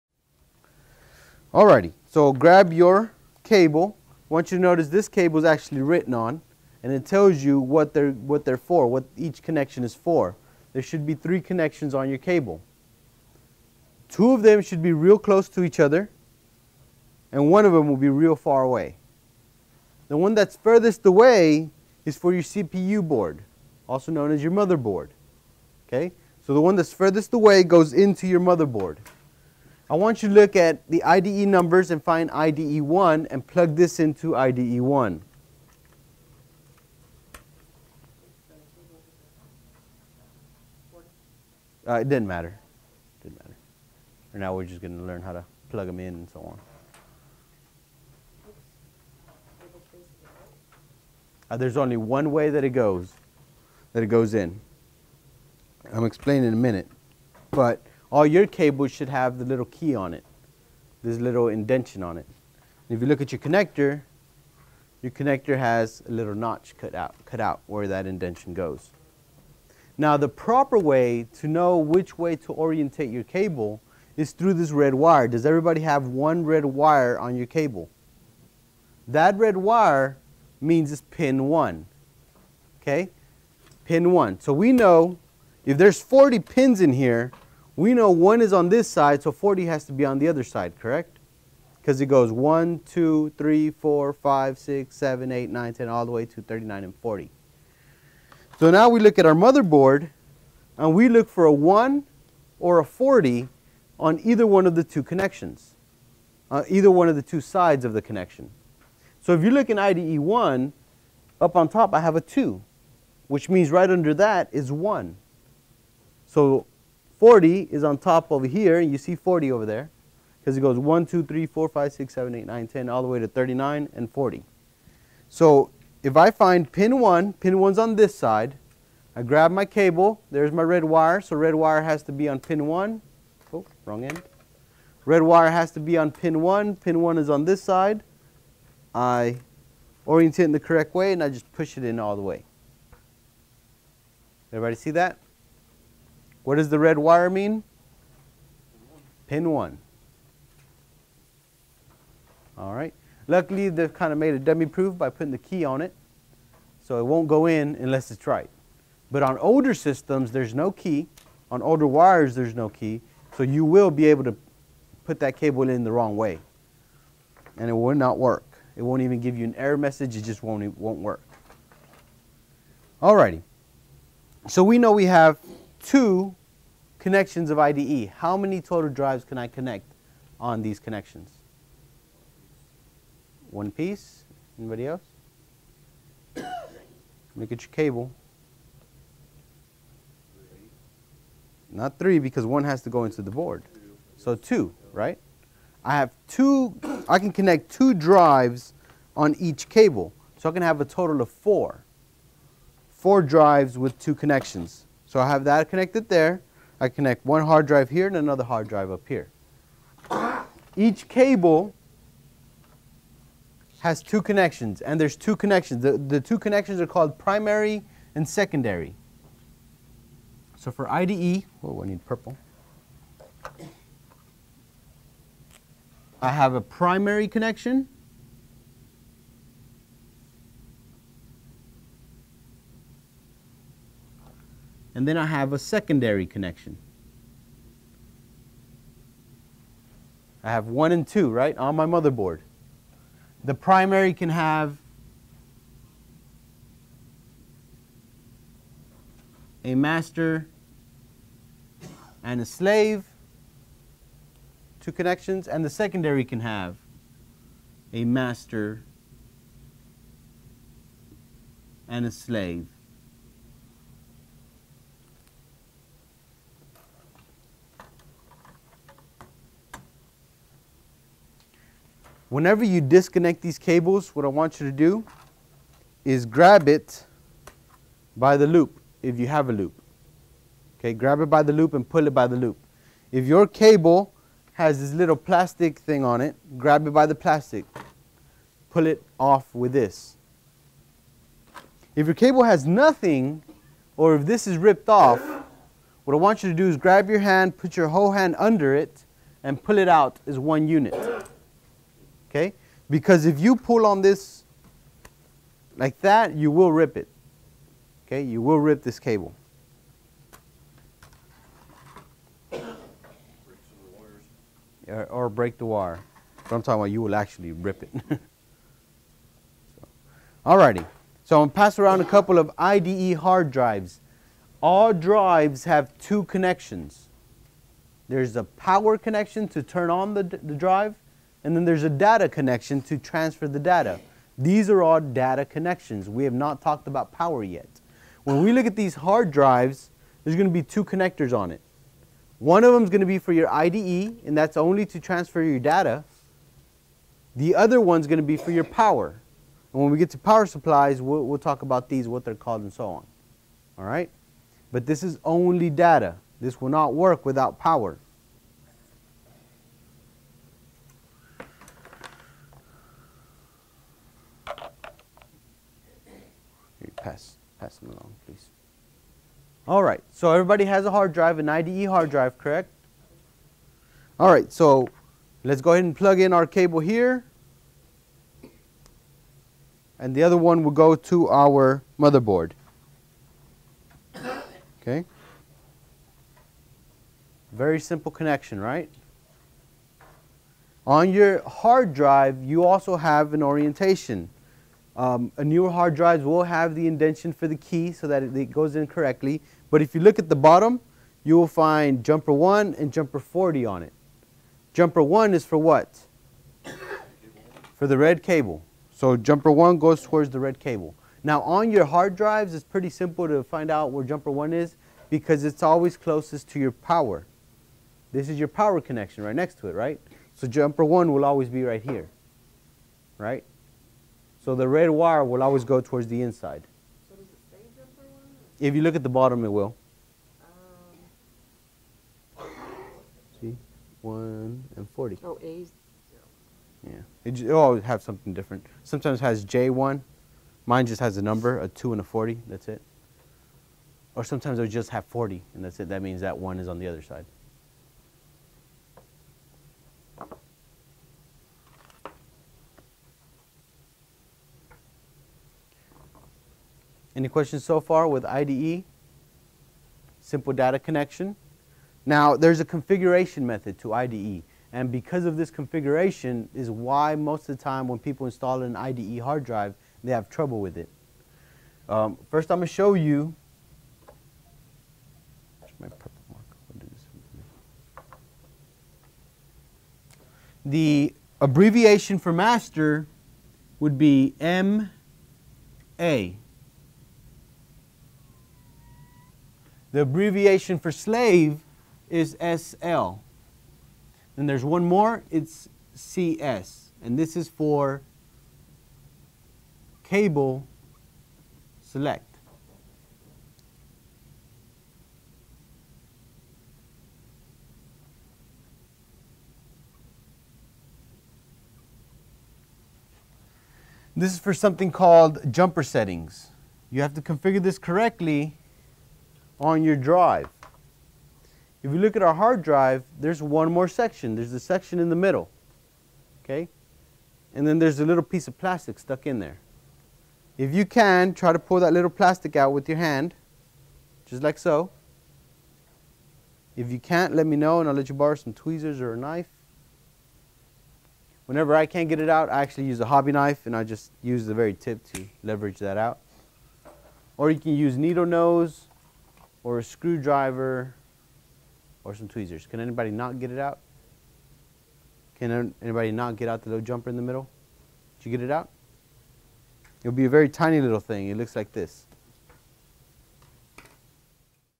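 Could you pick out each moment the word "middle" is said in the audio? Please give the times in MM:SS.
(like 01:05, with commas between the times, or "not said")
08:45, 09:17.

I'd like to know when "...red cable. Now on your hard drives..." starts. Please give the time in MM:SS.
06:50.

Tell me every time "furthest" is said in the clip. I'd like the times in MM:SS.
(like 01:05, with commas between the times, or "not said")
00:20, 00:26.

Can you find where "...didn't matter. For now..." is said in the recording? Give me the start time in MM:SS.
00:43.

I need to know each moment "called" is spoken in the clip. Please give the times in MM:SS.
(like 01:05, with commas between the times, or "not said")
03:36, 05:52, 08:34.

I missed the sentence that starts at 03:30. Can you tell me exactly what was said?
Each cable has two connections, and there's two connections.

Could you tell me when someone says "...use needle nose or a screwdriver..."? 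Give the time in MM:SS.
09:07.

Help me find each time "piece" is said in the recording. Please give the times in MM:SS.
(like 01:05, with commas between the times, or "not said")
03:03, 08:48.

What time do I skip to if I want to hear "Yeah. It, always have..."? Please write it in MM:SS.
07:16.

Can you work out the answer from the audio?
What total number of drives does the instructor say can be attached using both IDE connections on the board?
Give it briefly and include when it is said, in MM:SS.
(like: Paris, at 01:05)
Four, at 03:20.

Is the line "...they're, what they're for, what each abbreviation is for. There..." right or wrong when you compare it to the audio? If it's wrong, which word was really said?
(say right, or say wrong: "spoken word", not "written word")
wrong: "connection", not "abbreviation".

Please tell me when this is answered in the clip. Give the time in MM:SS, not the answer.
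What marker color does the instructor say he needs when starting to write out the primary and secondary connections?
03:41.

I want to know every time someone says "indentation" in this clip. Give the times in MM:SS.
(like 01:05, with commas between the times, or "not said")
01:01, 01:08, 06:36.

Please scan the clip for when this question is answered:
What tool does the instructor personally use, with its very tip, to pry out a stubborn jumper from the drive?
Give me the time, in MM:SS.
09:02.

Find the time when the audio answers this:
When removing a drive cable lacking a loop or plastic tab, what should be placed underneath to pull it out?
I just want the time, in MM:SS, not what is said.
04:57.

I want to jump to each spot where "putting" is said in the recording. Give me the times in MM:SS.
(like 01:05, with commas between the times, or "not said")
02:35.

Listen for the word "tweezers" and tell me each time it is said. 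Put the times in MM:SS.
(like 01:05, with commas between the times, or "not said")
08:58, 09:12.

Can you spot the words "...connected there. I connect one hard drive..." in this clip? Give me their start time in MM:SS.
03:25.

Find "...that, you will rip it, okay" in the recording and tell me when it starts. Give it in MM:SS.
05:06.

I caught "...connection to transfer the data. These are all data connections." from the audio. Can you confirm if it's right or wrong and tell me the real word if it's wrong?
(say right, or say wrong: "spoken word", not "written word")
right.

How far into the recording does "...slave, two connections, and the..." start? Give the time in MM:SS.
04:12.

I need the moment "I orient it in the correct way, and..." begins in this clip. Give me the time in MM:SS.
02:18.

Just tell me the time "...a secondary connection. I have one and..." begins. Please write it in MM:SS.
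03:55.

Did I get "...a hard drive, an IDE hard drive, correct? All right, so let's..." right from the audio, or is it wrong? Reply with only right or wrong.
right.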